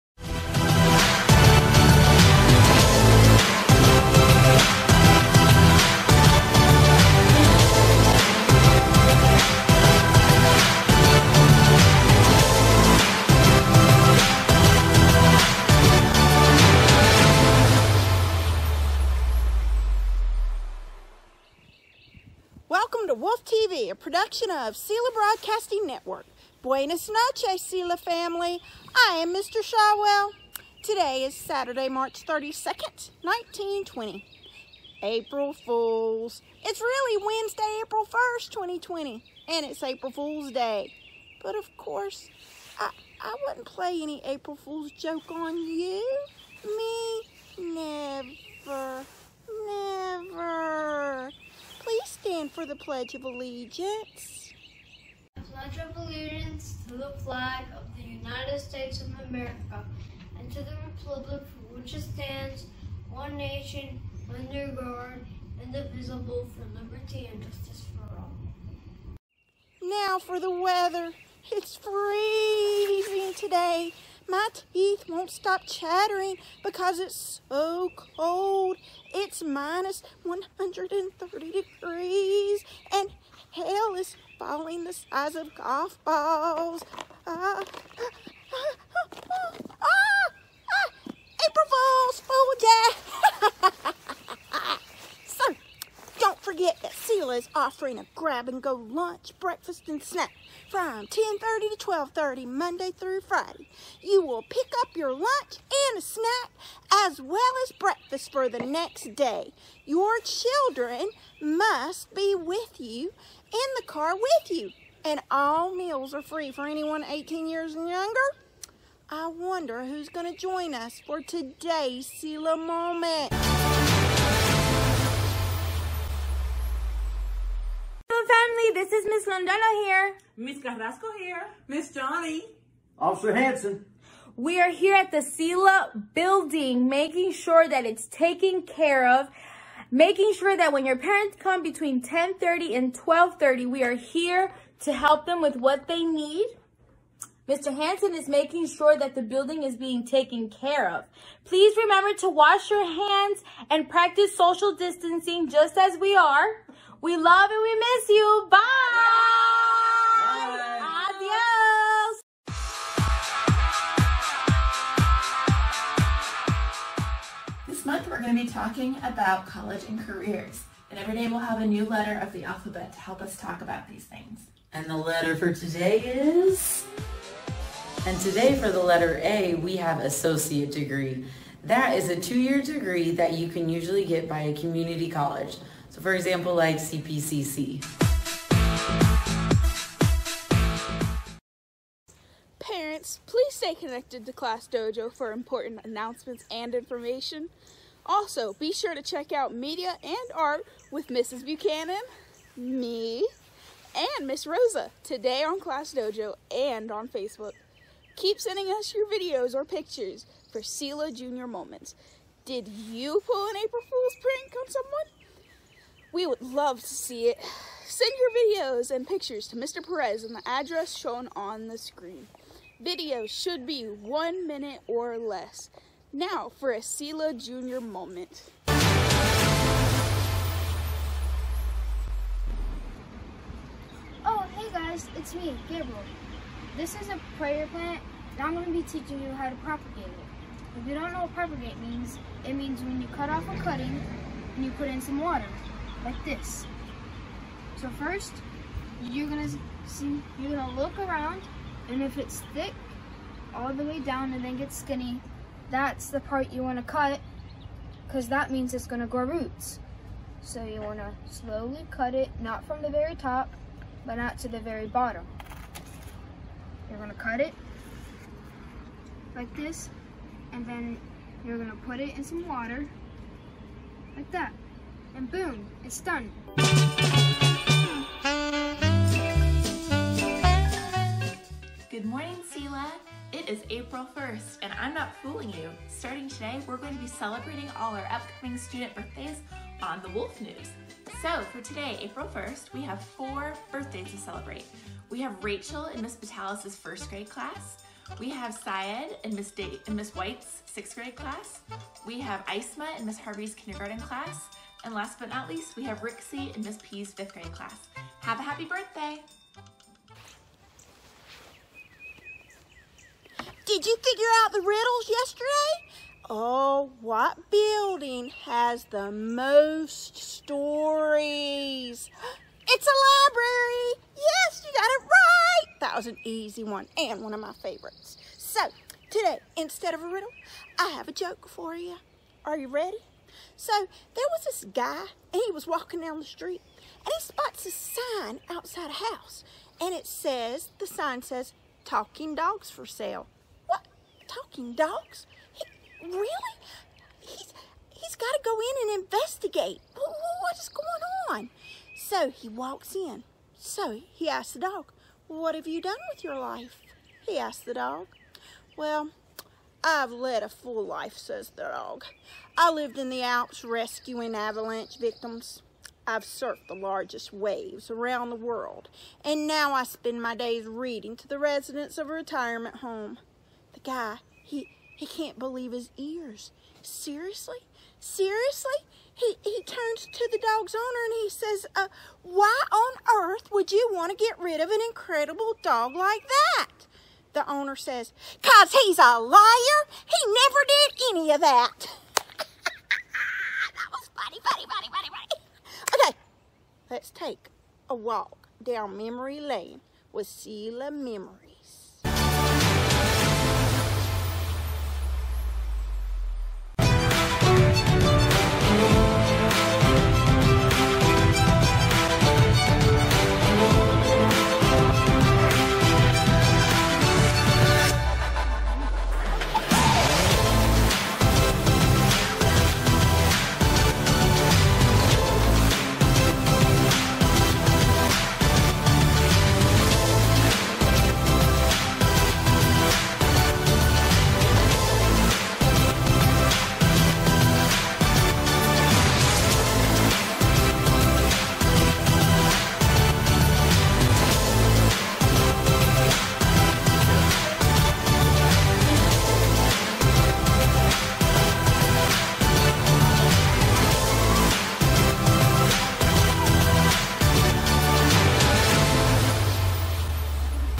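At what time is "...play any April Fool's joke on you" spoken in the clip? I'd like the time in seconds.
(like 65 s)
43 s.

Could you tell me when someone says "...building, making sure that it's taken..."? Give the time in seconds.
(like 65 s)
136 s.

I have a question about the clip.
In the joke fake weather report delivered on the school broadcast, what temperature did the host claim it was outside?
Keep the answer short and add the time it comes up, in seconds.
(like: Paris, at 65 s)
-130 degrees, at 79 s.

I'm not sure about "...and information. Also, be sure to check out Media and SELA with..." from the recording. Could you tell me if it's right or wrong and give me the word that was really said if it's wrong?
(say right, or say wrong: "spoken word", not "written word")
wrong: "Art", not "SELA".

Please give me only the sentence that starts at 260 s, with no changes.
So you want to slowly cut it, not from the very top, but not to the very bottom.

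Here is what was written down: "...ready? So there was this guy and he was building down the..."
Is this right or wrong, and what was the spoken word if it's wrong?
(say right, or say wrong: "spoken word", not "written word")
wrong: "walking", not "building".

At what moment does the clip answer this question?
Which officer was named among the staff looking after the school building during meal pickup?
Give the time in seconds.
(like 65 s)
132 s.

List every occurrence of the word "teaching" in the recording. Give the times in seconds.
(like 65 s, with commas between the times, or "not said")
238 s.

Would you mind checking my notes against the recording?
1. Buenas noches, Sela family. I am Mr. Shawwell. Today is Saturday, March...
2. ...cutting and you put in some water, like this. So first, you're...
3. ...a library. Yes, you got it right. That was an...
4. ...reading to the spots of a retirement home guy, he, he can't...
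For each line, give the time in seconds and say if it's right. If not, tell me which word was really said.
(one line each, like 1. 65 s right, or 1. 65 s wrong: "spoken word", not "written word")
1. 26 s right
2. 243 s right
3. 322 s right
4. 370 s wrong: "residents", not "spots".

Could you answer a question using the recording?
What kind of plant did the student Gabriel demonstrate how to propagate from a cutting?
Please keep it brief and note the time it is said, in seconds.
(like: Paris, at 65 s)
prayer plant, at 237 s.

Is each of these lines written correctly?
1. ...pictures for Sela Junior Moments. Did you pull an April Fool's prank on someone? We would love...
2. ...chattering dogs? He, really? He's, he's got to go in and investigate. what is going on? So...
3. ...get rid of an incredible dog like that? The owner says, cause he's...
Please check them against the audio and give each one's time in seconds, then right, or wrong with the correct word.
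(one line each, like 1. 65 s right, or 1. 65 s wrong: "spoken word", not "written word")
1. 209 s right
2. 344 s wrong: "talking", not "chattering"
3. 384 s right.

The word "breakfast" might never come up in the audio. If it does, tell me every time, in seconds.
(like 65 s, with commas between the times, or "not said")
99 s, 107 s.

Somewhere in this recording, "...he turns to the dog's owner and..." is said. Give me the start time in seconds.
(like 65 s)
379 s.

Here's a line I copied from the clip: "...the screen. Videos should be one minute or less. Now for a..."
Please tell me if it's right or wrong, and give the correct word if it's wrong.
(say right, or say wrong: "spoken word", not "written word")
right.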